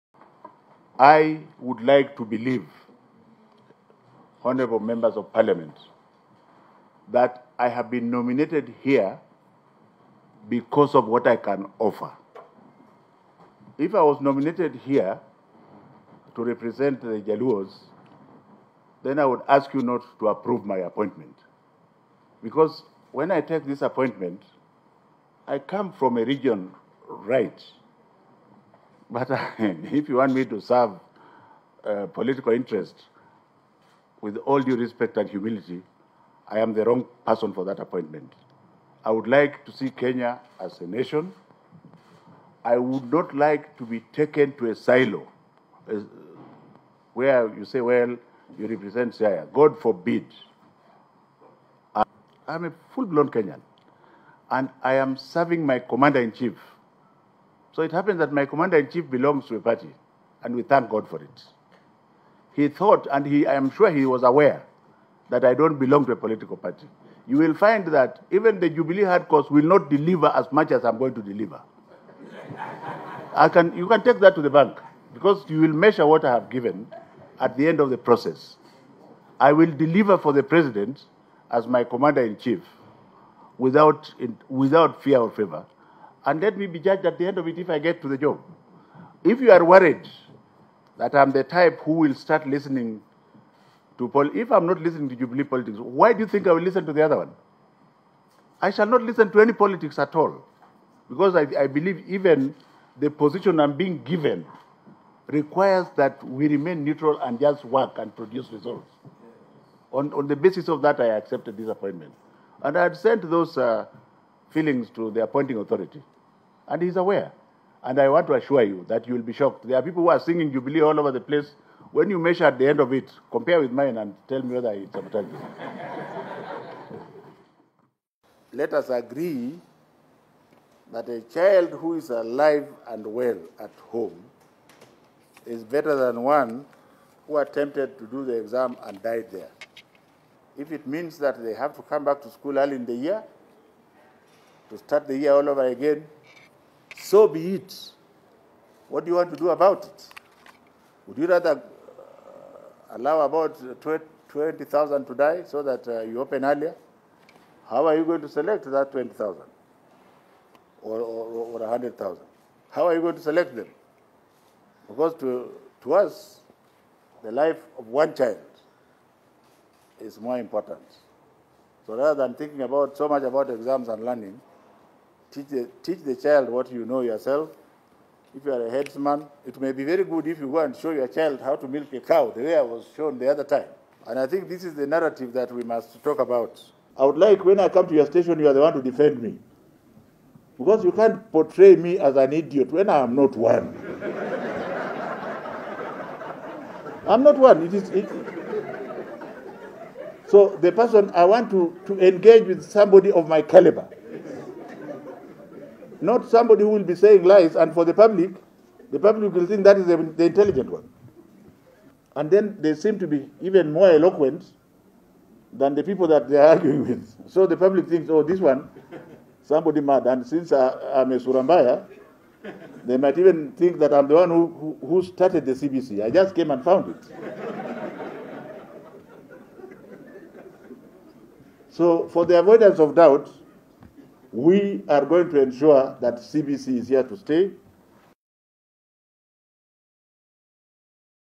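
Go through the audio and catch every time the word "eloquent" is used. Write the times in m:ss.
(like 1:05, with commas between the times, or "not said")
3:33.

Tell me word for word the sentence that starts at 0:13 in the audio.
If I was nominated here to represent the Jaluos, then I would ask you not to approve my appointment.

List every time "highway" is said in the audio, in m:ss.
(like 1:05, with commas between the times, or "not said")
not said.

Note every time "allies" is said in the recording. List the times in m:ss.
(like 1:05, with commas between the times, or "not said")
not said.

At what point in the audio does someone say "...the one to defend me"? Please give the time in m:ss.
3:08.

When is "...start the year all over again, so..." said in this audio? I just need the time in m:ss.
2:24.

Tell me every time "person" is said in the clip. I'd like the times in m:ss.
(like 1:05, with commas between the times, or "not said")
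0:37, 3:20.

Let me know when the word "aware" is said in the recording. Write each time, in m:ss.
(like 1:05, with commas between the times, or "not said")
1:04, 1:56.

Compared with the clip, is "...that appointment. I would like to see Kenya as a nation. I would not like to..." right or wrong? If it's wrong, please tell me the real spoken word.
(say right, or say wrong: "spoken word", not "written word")
right.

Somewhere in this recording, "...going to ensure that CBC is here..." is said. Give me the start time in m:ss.
3:55.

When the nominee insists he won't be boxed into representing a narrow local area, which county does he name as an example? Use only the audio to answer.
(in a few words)
Siaya.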